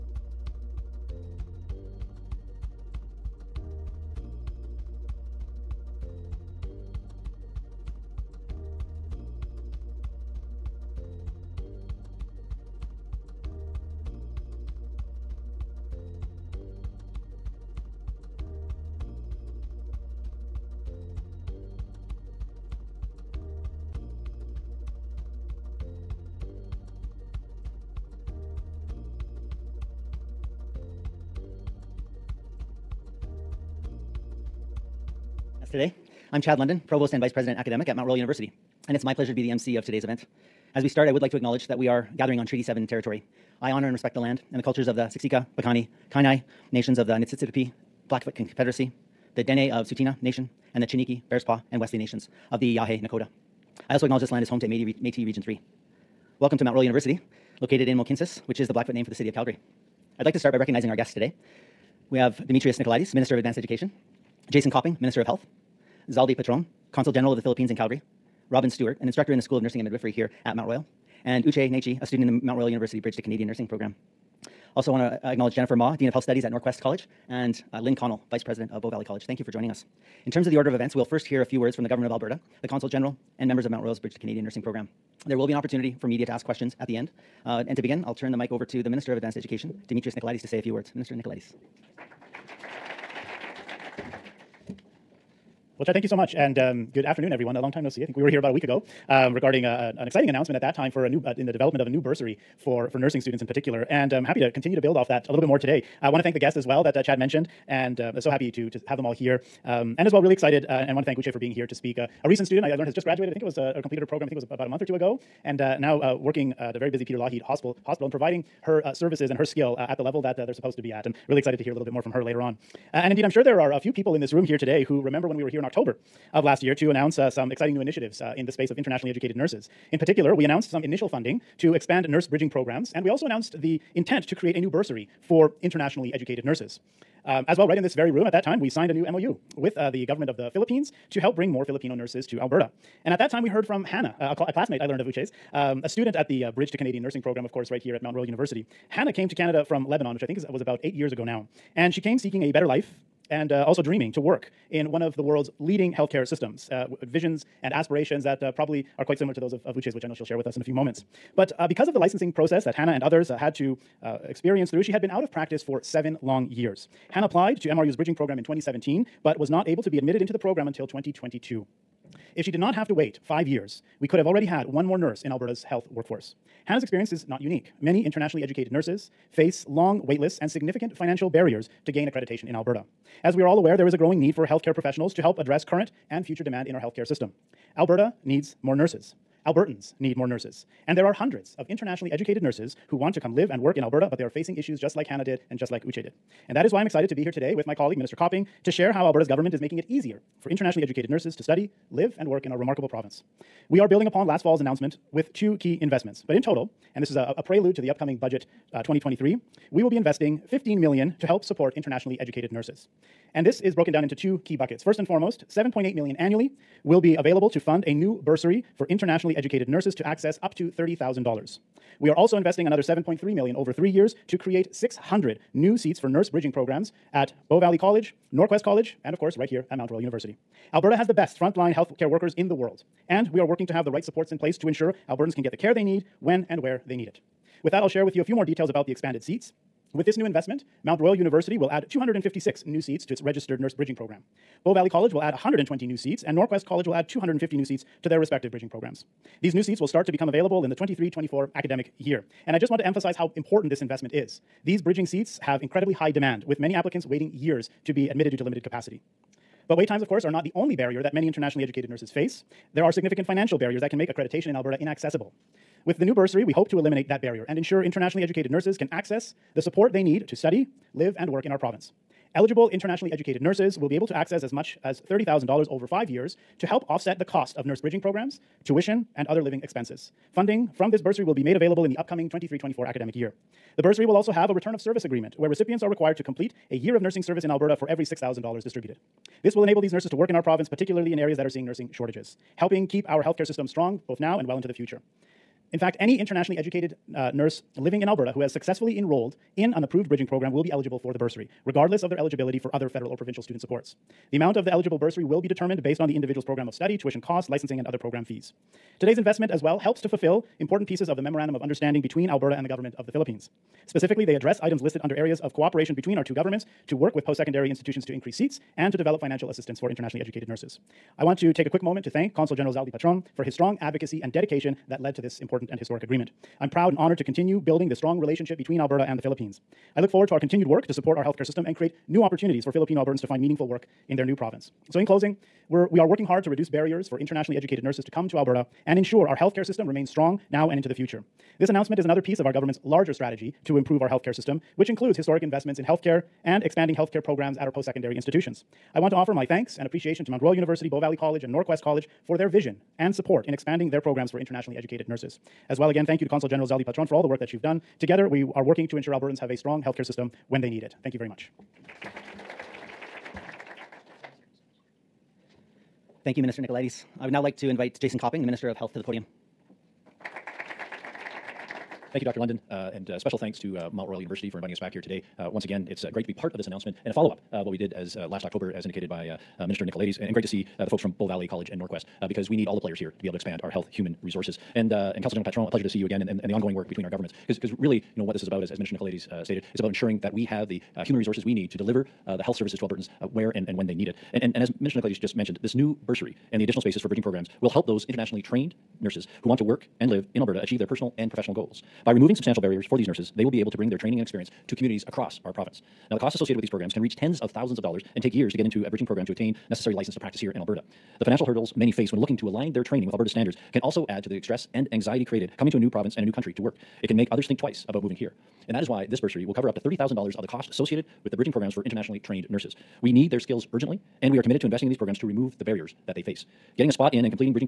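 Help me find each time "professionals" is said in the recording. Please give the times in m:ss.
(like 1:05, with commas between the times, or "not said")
3:04, 6:41.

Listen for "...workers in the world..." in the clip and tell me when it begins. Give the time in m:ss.
3:52.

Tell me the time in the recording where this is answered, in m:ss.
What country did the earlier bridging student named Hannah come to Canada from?
2:29.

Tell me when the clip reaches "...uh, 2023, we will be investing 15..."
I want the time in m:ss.
3:28.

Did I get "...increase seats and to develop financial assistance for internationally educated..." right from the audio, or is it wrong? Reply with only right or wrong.
right.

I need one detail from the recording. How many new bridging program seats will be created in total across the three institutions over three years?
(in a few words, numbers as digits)
600.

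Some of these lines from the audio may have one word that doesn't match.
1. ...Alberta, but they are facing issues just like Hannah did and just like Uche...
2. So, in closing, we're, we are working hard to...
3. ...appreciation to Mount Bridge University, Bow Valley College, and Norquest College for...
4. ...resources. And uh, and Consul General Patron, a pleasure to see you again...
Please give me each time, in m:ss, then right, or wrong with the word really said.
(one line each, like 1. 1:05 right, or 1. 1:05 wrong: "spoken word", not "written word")
1. 3:13 right
2. 5:34 right
3. 5:49 wrong: "Royal", not "Bridge"
4. 6:24 right.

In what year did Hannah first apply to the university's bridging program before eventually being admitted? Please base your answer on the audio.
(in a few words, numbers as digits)
2017.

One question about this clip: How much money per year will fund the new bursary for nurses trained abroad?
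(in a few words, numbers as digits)
7.8 million.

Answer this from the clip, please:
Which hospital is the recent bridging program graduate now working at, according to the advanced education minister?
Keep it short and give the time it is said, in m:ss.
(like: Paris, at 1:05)
Peter Lougheed Hospital, at 1:57.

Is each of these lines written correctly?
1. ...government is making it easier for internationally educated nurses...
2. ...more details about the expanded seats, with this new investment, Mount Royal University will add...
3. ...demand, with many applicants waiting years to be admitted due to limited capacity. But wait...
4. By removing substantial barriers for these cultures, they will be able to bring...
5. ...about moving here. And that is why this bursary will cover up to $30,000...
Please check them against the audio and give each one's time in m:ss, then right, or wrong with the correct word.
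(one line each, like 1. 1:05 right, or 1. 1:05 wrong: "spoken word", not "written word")
1. 3:19 right
2. 3:58 right
3. 4:16 right
4. 6:42 wrong: "nurses", not "cultures"
5. 6:57 right.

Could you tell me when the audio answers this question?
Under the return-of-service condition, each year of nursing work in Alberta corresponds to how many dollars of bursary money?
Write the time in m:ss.
4:48.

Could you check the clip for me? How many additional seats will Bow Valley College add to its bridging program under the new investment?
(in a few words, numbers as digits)
120.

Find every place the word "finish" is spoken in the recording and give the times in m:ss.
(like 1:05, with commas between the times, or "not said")
not said.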